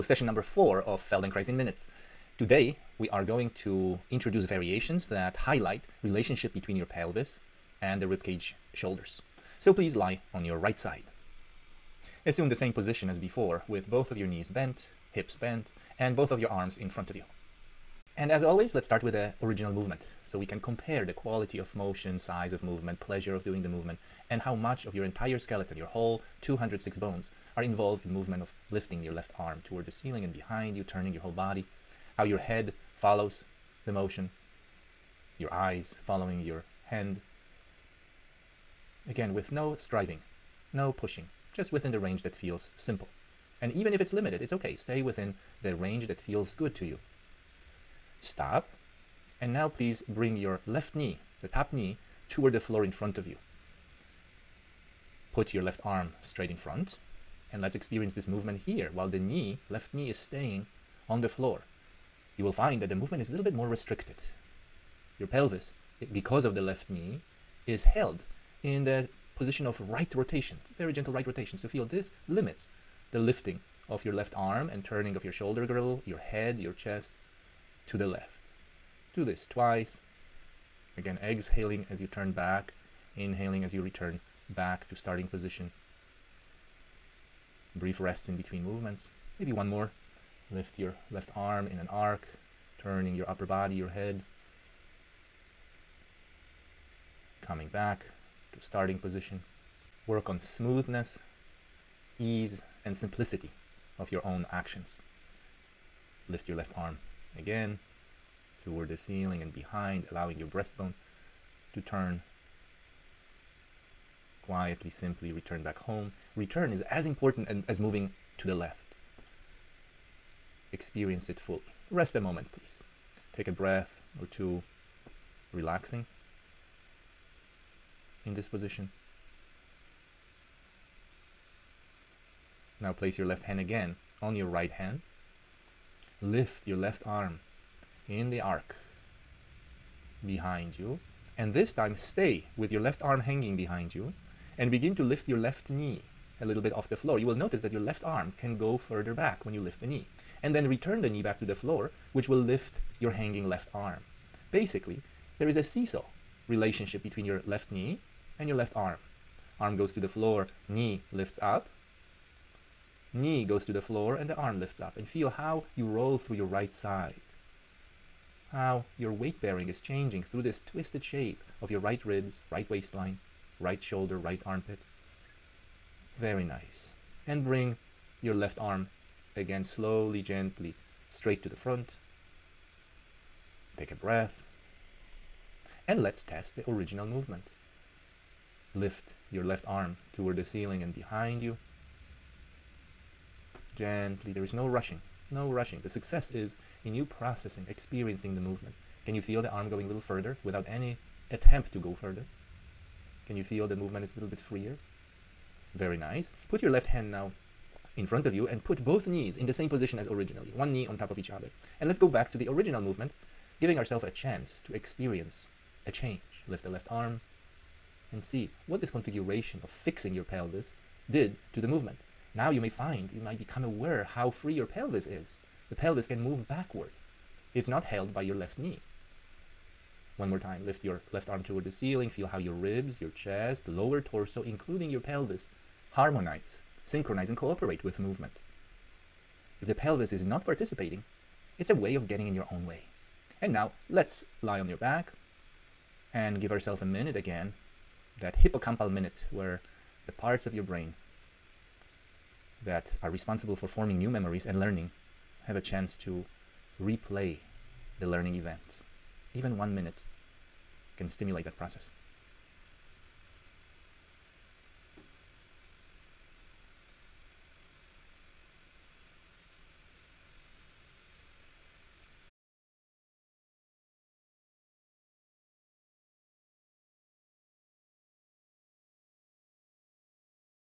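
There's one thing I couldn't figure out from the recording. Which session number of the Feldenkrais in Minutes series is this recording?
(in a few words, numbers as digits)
4.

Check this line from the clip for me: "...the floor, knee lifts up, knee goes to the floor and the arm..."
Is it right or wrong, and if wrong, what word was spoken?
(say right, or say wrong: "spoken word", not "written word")
right.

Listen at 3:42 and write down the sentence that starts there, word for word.
Now you may find, you might become aware how free your pelvis is.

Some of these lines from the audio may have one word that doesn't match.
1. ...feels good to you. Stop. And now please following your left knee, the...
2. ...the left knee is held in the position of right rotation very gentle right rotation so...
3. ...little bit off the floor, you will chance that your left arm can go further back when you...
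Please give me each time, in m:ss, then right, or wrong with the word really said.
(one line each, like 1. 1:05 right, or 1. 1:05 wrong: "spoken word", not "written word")
1. 0:46 wrong: "bring", not "following"
2. 1:06 right
3. 2:26 wrong: "notice", not "chance".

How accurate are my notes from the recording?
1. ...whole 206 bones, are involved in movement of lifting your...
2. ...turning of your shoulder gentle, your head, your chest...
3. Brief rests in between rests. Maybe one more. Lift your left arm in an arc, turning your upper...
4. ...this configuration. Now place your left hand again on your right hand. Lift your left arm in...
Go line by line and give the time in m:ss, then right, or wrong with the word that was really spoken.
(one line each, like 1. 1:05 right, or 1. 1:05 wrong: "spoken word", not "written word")
1. 0:25 right
2. 1:14 wrong: "girdle", not "gentle"
3. 1:27 wrong: "movements", not "rests"
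4. 2:08 wrong: "position", not "configuration".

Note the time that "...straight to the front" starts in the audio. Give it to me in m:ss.
3:01.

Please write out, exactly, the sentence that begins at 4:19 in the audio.
Even one minute can stimulate that process.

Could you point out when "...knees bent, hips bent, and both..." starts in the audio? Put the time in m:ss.
0:14.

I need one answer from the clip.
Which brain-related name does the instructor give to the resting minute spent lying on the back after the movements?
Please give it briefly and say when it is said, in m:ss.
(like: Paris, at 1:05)
hippocampal minute, at 4:08.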